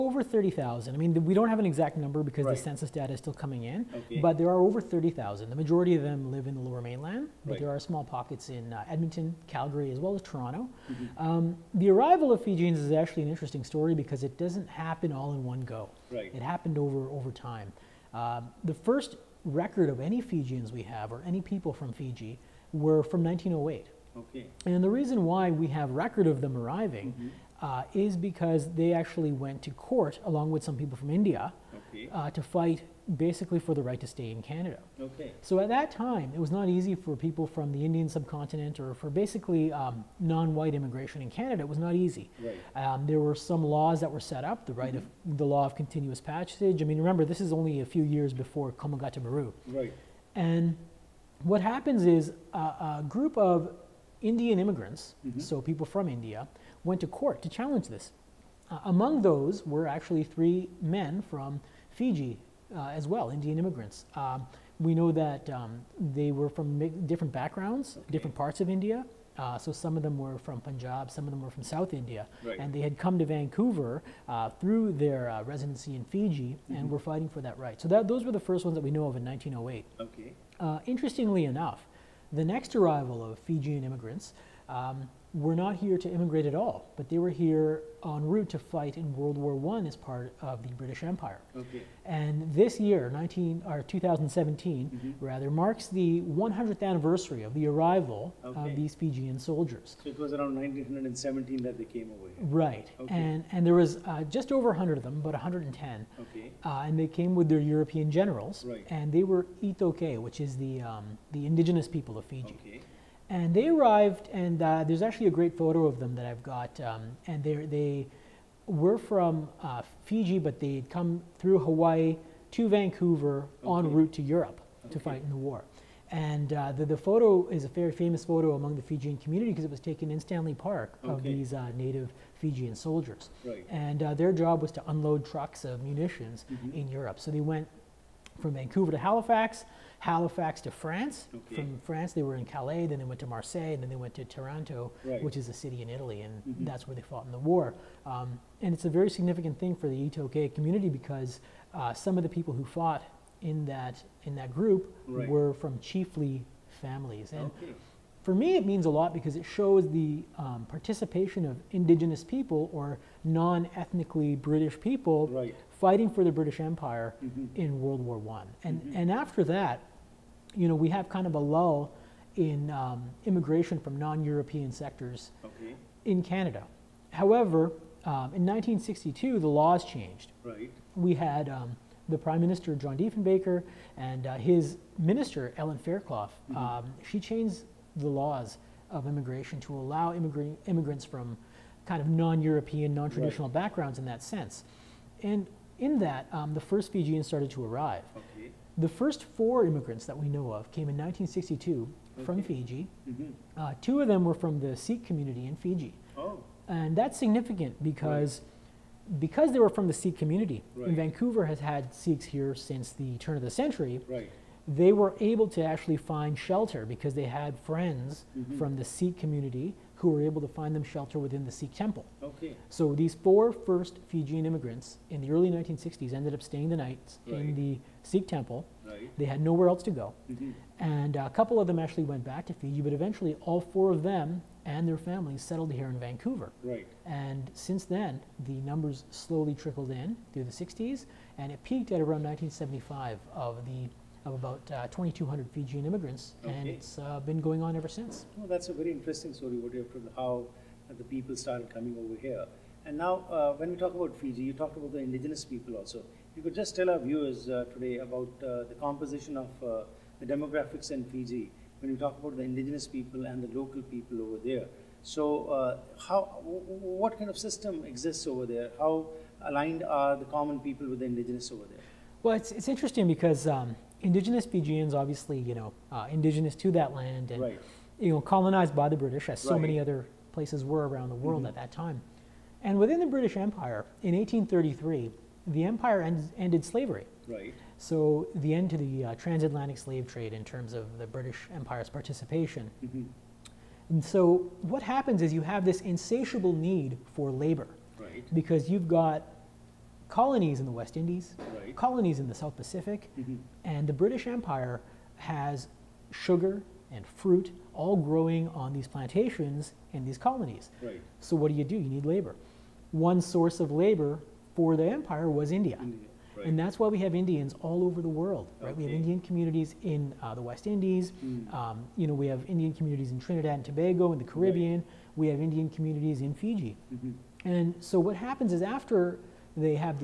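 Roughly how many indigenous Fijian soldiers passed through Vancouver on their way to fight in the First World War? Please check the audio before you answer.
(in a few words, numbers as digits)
about 110.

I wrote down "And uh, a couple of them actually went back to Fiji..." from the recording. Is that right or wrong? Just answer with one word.
right.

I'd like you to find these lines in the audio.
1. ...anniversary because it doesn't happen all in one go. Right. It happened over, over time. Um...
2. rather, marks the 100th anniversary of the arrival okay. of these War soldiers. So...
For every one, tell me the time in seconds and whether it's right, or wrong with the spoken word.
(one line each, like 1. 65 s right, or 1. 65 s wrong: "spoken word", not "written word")
1. 13 s wrong: "story", not "anniversary"
2. 95 s wrong: "Fijian", not "War".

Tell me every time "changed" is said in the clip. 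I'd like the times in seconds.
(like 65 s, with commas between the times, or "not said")
179 s, 187 s.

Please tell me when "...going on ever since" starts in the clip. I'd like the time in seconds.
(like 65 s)
247 s.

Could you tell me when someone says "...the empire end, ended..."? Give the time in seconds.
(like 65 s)
285 s.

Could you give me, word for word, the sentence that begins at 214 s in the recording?
they were able to actually find shelter because they had friends mm-hmm.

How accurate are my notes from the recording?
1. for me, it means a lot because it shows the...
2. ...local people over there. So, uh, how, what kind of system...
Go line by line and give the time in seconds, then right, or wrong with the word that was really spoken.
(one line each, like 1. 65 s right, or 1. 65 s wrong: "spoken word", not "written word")
1. 158 s right
2. 263 s right.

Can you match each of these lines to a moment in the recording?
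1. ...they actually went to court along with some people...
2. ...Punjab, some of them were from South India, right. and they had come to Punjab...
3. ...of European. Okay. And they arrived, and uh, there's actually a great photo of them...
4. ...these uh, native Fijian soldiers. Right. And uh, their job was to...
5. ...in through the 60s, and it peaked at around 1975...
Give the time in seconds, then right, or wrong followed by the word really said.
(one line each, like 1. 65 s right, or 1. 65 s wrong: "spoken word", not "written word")
1. 28 s right
2. 70 s wrong: "Vancouver", not "Punjab"
3. 112 s wrong: "Fiji", not "European"
4. 131 s right
5. 239 s right.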